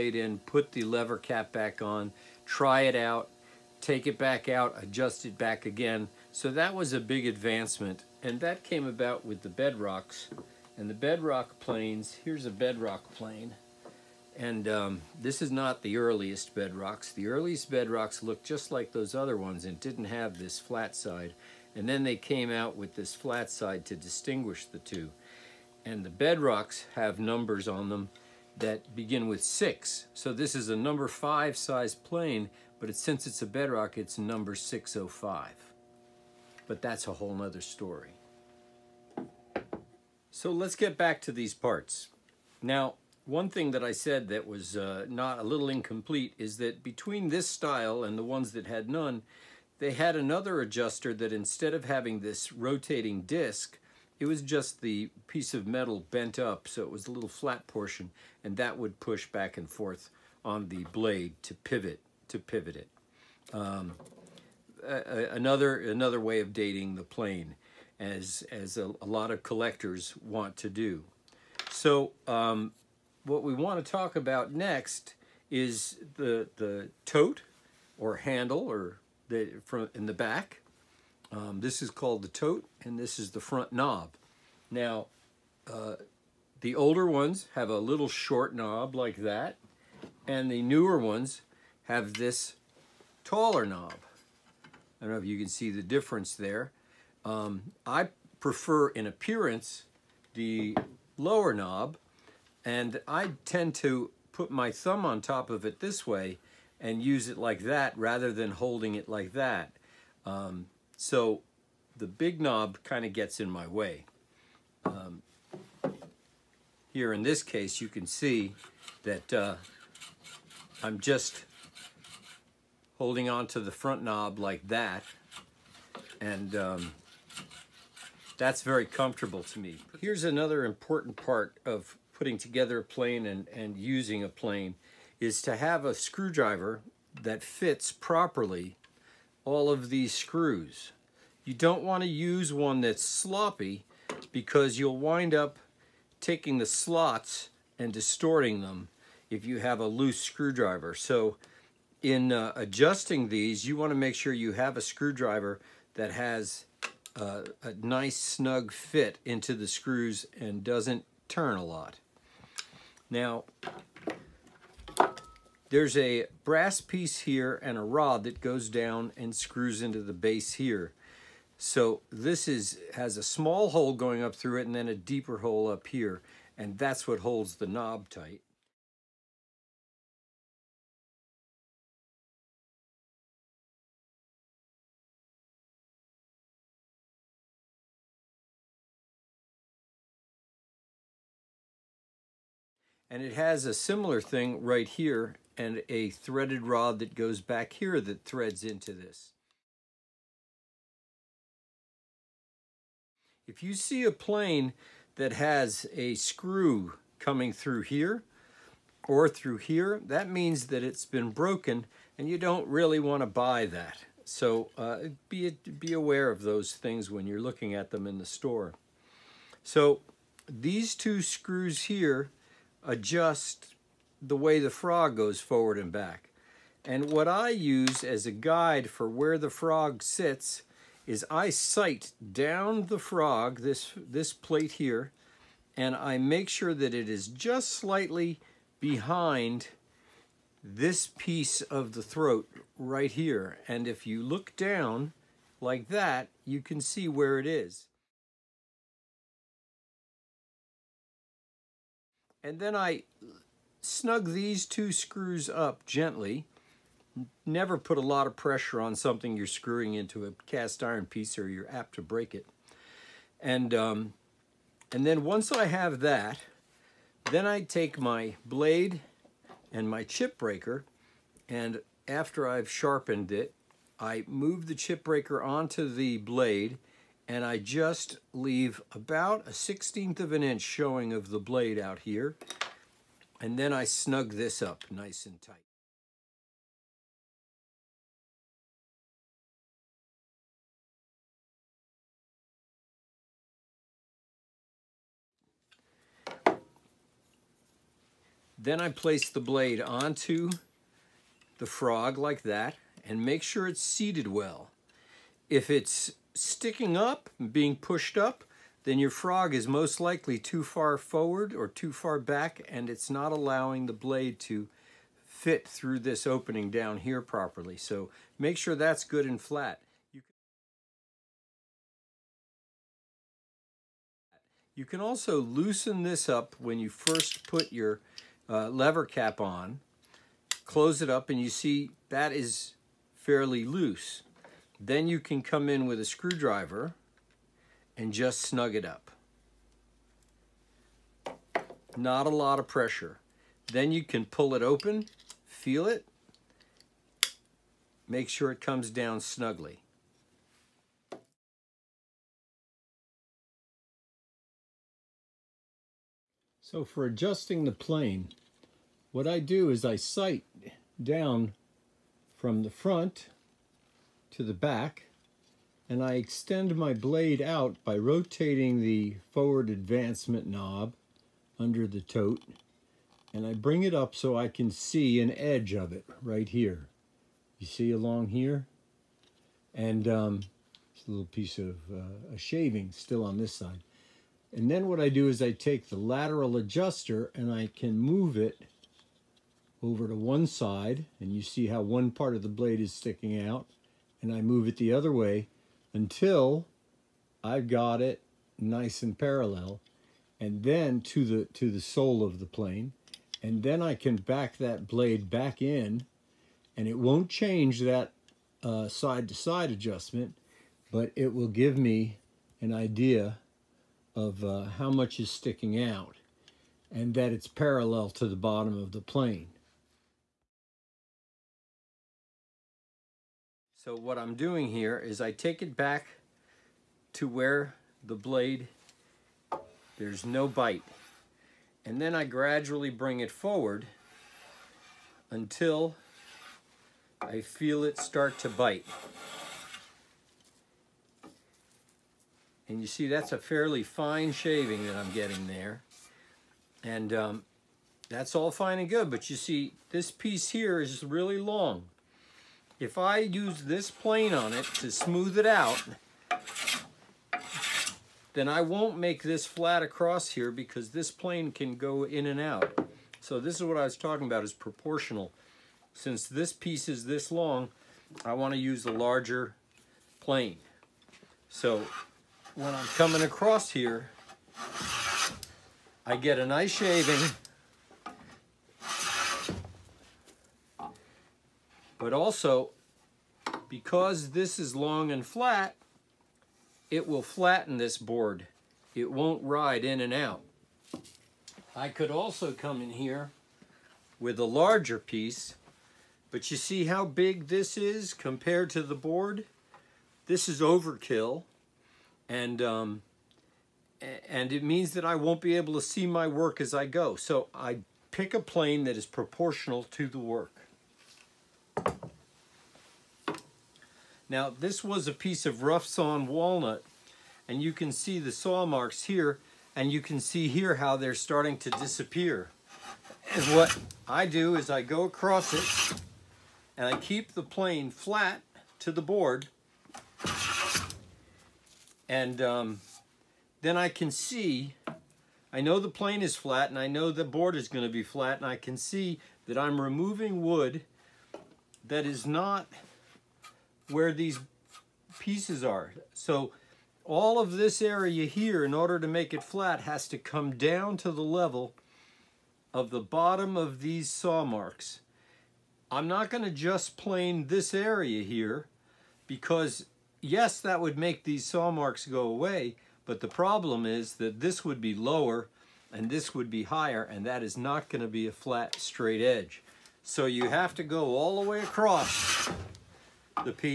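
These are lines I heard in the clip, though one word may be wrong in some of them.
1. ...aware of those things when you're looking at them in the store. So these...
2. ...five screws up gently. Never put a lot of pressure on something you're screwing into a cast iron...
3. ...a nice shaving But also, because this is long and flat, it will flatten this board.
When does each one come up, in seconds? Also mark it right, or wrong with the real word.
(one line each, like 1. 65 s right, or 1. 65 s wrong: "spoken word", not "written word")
1. 215 s right
2. 254 s wrong: "two", not "five"
3. 476 s right.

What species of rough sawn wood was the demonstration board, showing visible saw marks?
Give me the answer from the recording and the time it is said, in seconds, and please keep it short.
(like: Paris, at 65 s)
walnut, at 516 s.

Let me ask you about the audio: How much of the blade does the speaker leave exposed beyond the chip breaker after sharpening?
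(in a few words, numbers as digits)
a 16th of an inch.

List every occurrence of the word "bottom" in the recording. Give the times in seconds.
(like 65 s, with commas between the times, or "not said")
418 s, 552 s.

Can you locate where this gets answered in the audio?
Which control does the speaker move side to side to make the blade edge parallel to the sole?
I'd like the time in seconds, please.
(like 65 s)
385 s.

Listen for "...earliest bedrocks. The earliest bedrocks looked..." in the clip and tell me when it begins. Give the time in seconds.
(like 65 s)
15 s.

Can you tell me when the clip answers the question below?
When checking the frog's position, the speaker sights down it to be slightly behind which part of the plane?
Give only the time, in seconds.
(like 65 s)
242 s.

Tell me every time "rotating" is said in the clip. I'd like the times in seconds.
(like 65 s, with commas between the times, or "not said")
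52 s, 367 s.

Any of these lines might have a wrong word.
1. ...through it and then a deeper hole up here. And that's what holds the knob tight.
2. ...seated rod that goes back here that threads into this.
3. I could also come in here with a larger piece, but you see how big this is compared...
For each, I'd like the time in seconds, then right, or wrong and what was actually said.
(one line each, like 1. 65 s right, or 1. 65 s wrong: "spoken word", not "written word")
1. 174 s right
2. 196 s wrong: "threaded", not "seated"
3. 491 s right.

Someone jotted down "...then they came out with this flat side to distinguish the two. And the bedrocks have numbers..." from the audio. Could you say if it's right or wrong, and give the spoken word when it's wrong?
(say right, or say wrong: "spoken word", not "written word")
right.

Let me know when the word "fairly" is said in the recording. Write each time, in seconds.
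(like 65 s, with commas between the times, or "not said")
333 s, 443 s.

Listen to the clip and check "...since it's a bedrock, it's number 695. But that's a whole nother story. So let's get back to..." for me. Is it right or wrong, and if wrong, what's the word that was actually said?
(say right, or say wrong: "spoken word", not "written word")
wrong: "605", not "695".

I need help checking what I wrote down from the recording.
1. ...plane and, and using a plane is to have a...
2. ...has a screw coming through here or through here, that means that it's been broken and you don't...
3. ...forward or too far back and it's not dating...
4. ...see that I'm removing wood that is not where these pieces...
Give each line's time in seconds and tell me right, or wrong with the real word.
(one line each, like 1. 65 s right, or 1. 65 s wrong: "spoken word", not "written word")
1. 132 s right
2. 205 s right
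3. 310 s wrong: "allowing", not "dating"
4. 538 s right.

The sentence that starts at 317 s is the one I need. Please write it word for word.
So make sure that's good and flat.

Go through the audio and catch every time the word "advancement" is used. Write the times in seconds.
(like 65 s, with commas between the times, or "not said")
7 s, 369 s.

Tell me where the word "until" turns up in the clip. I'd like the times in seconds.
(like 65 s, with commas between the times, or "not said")
395 s, 435 s.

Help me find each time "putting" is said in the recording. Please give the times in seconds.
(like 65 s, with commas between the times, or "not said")
132 s.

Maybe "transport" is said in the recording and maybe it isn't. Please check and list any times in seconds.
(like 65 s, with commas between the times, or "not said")
not said.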